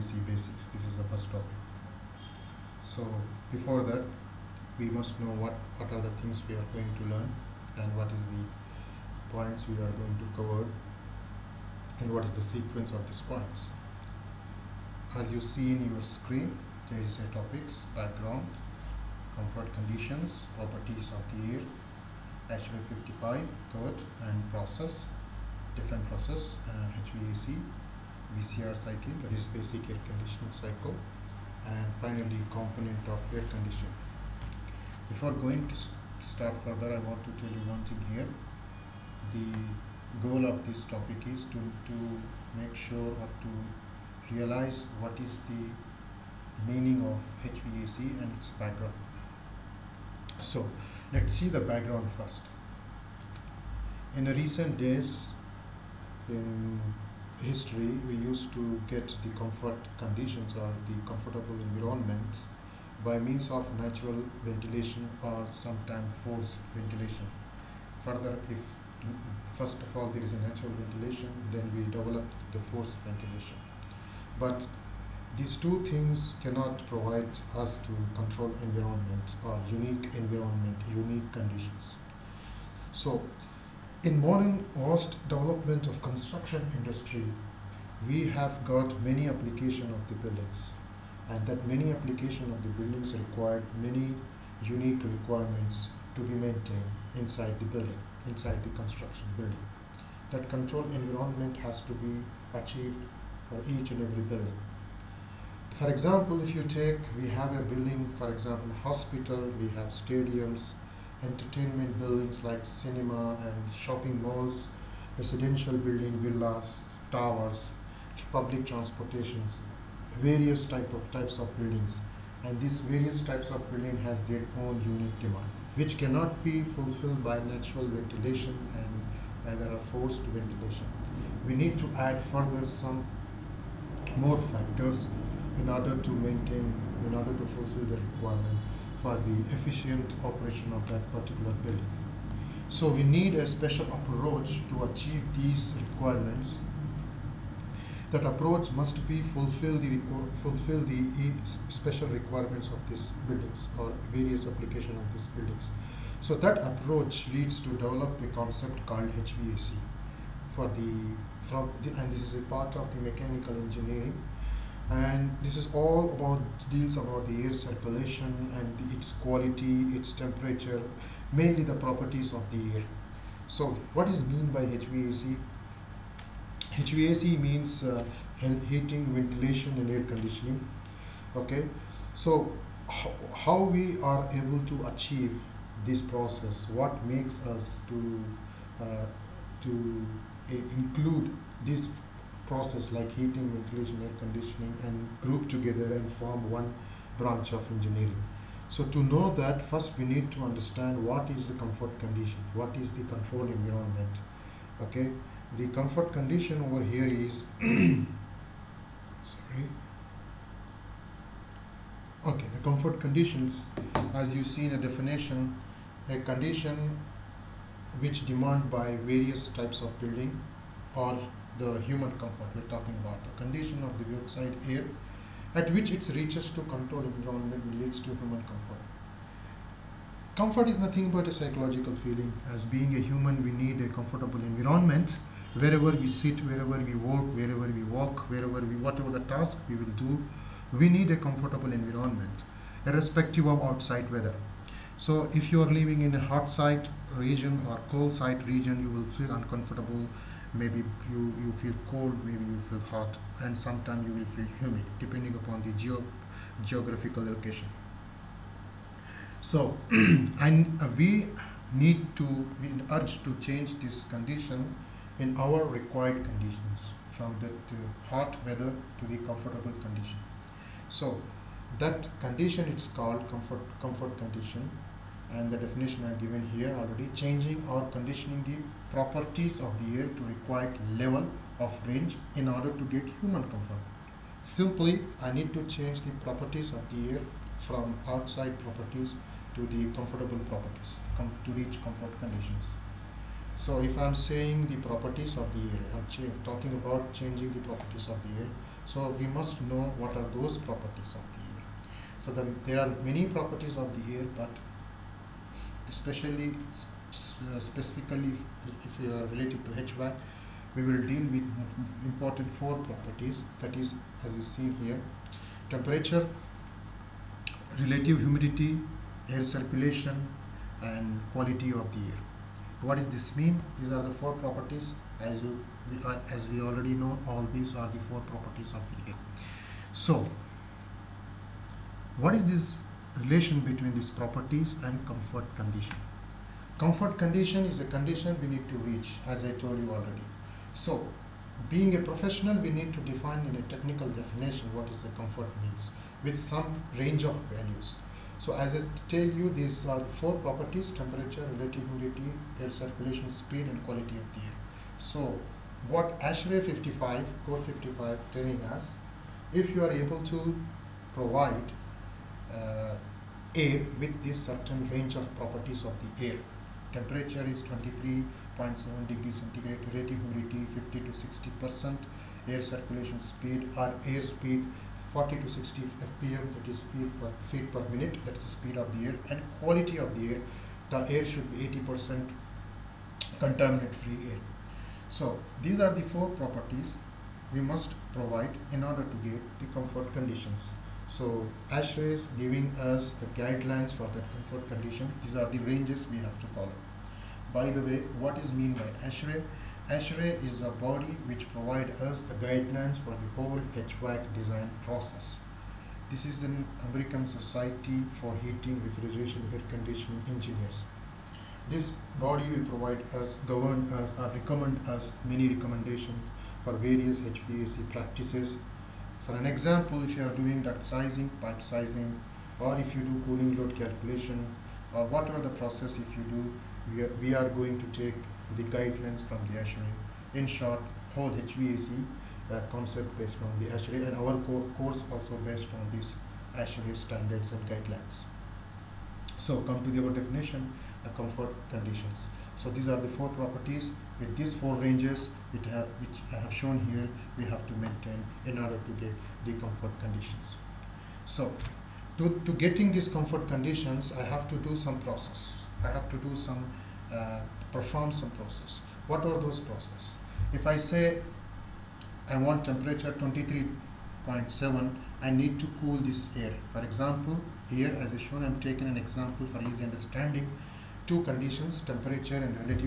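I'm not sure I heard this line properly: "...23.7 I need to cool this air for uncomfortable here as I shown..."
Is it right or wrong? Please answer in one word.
wrong.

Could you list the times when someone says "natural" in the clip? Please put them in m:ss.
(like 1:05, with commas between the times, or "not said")
1:03, 1:10, 2:07.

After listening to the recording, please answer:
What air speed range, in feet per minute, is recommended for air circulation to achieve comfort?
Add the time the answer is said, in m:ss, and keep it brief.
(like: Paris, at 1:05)
40 to 60 fpm, at 6:15.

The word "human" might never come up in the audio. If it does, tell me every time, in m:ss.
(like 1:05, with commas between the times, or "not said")
3:41, 3:48, 3:52, 4:43.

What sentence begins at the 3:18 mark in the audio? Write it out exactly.
So to know that first we need to understand what is the comfort condition, what is the control environment.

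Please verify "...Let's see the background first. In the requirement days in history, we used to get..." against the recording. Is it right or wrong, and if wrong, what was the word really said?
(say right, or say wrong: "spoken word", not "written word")
wrong: "recent", not "requirement".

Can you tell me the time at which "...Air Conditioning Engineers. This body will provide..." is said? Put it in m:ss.
6:49.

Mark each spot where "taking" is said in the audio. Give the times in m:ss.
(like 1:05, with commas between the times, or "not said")
7:48.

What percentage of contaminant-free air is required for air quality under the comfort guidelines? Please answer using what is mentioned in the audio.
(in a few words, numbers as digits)
80 percent.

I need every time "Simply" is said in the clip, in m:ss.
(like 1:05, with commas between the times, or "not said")
4:44.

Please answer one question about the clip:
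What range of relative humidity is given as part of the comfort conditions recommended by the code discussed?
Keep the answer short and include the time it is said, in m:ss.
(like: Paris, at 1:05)
50 to 60 percent, at 6:10.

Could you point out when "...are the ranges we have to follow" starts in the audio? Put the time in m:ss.
6:35.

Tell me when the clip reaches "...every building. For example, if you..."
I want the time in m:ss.
1:44.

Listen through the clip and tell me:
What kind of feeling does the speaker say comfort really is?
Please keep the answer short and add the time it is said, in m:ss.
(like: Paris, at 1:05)
psychological, at 3:51.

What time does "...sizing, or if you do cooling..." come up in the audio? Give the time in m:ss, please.
7:01.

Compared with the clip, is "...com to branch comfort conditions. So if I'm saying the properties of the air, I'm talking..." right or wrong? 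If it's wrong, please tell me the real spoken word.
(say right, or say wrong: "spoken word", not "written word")
wrong: "reach", not "branch".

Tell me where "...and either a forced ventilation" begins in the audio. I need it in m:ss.
2:08.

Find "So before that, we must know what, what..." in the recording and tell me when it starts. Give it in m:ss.
0:02.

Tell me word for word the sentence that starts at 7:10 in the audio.
In short, whole HVAC uh, concept based on the ASHRAE and our co course also based on these ASHRAE standards and guidelines.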